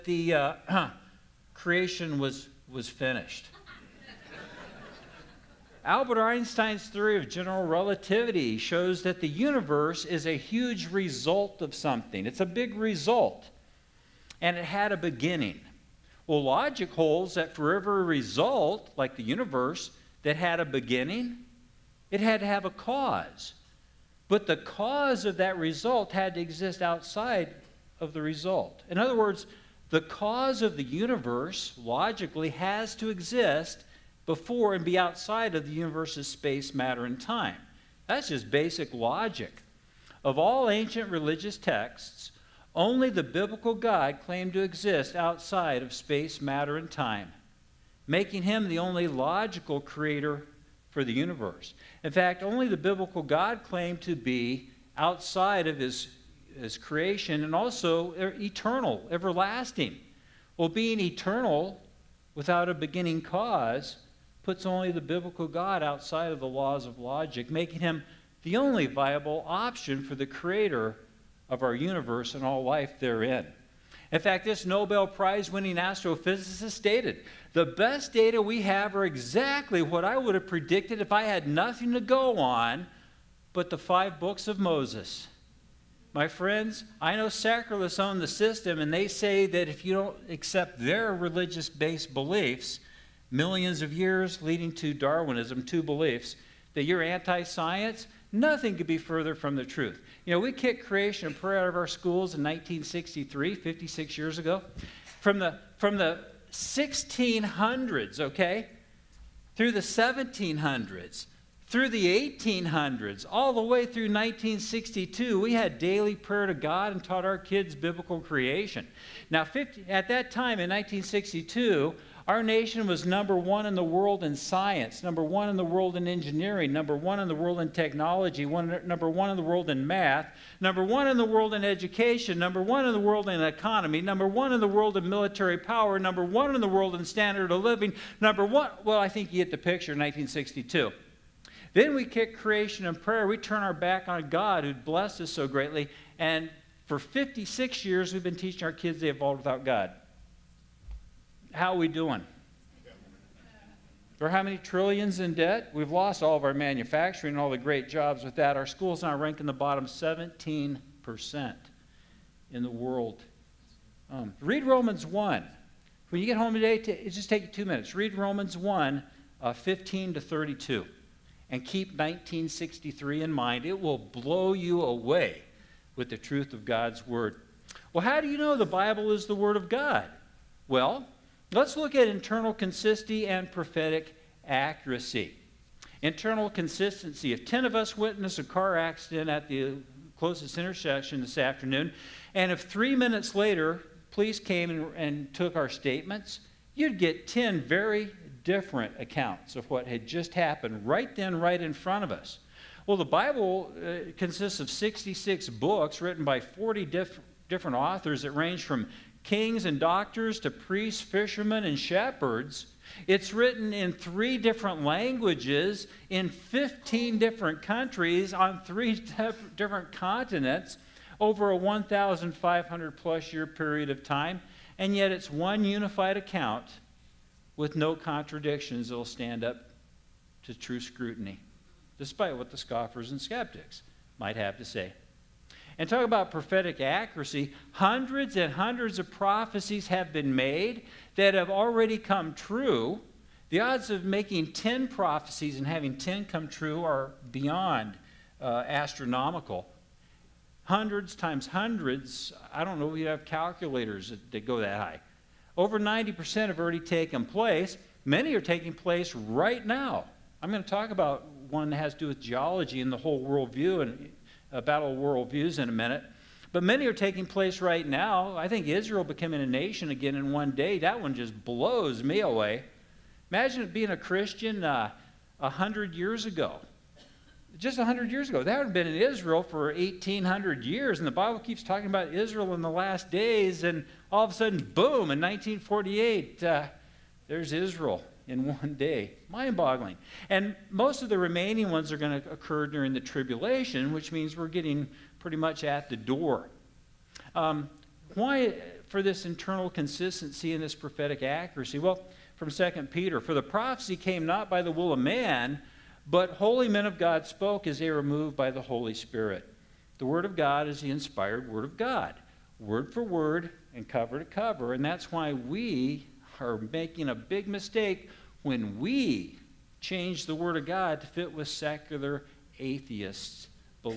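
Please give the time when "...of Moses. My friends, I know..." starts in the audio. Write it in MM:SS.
01:24.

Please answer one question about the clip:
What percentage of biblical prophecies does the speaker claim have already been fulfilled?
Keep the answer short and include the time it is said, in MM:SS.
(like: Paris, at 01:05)
Over 90%, at 04:15.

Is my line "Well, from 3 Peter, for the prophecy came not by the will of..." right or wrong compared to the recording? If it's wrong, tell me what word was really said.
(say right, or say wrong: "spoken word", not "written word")
wrong: "2", not "3".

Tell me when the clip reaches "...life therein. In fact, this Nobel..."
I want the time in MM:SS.
01:12.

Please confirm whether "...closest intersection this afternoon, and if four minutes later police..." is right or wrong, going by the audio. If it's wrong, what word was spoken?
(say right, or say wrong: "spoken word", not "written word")
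wrong: "three", not "four".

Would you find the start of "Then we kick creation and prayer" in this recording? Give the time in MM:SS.
02:21.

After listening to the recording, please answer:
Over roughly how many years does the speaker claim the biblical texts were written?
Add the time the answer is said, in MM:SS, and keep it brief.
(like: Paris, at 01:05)
1,500 plus years, at 03:41.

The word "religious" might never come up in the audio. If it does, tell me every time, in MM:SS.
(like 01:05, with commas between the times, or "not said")
00:41, 01:31.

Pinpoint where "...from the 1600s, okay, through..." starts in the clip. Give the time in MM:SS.
01:45.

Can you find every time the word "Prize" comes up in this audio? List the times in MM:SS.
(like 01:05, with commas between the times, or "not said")
01:15.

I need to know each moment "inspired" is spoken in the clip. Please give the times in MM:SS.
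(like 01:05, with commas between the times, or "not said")
05:10.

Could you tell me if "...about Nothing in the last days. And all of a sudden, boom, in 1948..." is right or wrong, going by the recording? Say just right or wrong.
wrong.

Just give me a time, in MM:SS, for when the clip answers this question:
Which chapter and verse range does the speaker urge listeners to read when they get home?
02:48.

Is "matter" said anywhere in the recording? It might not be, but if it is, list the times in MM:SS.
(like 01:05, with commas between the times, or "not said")
00:36, 00:46.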